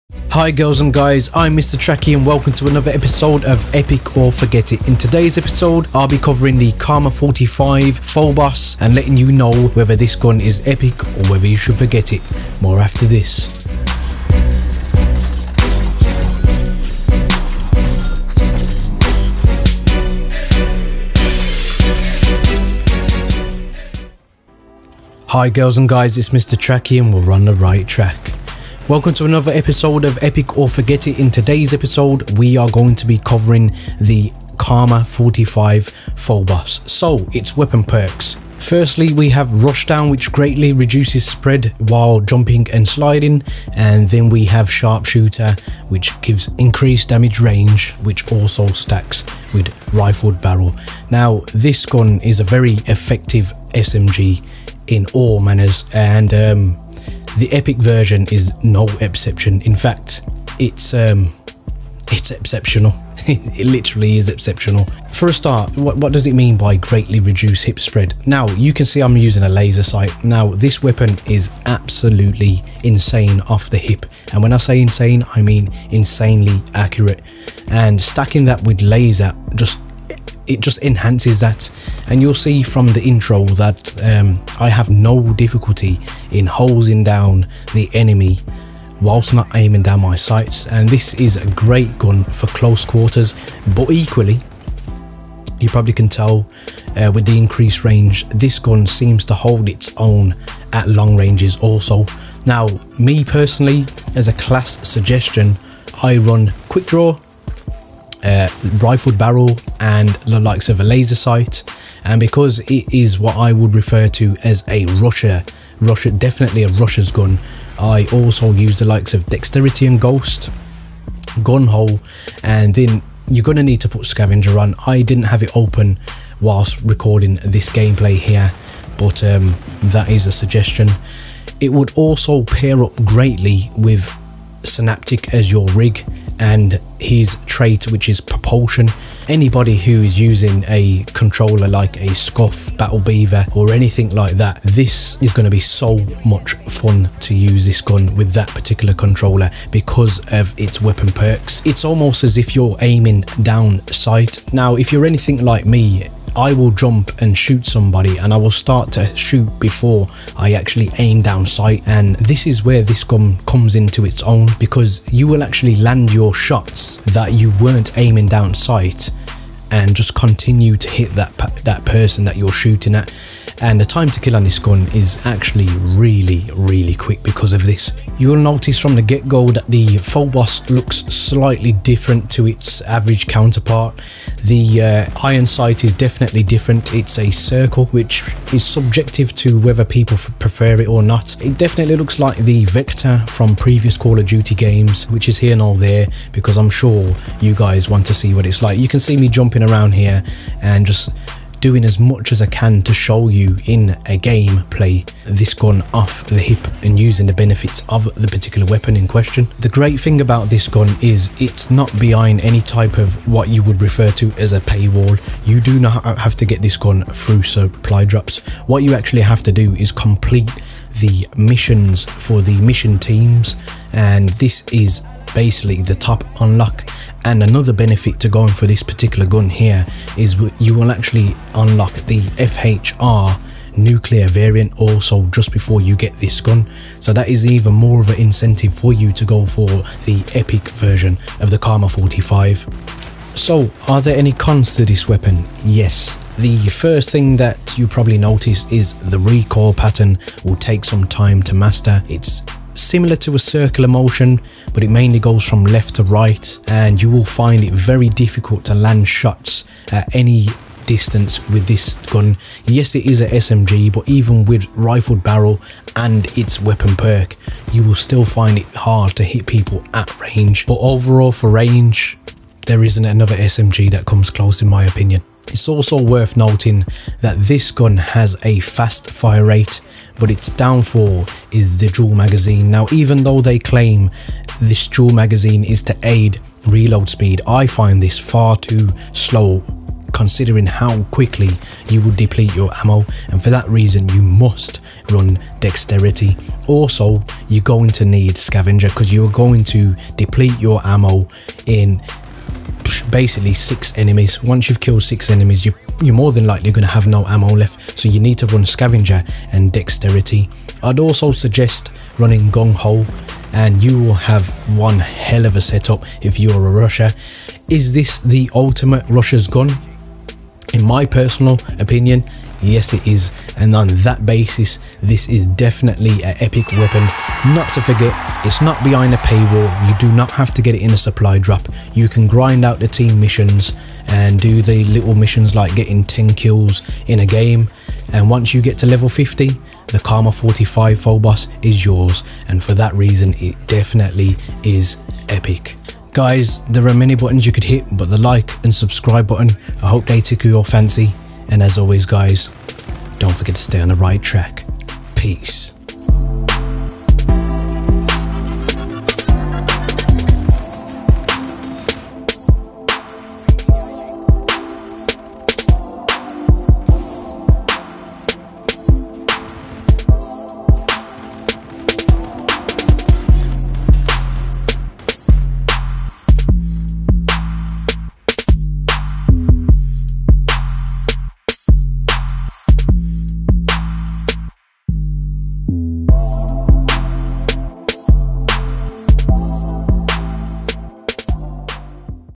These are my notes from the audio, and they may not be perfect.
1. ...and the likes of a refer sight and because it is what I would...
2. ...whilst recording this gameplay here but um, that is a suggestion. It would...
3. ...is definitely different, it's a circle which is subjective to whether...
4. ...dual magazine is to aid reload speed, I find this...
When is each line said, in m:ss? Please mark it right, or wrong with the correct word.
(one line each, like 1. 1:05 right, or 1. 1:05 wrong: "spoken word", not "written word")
1. 1:49 wrong: "laser", not "refer"
2. 2:06 right
3. 3:05 right
4. 4:44 right.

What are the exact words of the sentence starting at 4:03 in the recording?
So are there any cons to this weapon?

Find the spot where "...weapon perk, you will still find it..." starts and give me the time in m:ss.
4:26.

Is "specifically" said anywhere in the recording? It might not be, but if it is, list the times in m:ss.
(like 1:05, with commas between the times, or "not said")
not said.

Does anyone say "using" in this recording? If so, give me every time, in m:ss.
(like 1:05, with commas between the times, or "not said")
1:09, 2:20, 3:26.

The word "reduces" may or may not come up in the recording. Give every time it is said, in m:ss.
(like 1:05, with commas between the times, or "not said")
0:40, 1:07.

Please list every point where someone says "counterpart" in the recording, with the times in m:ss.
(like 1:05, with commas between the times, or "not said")
3:03.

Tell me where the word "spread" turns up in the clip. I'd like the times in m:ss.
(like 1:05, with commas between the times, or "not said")
0:41, 1:07.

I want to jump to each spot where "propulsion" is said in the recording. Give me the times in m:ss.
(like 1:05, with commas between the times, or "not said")
2:18.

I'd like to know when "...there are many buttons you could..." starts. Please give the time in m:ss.
5:46.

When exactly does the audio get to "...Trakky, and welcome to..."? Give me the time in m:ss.
0:01.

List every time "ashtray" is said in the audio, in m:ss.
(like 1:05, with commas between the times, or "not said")
not said.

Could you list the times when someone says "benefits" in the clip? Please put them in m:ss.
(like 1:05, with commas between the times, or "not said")
3:27, 3:47.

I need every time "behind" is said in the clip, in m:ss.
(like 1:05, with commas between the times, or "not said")
3:31, 5:28.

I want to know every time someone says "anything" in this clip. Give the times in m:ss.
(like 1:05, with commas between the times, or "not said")
2:23, 2:35.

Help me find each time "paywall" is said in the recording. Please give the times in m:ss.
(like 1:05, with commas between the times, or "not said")
3:34, 5:29.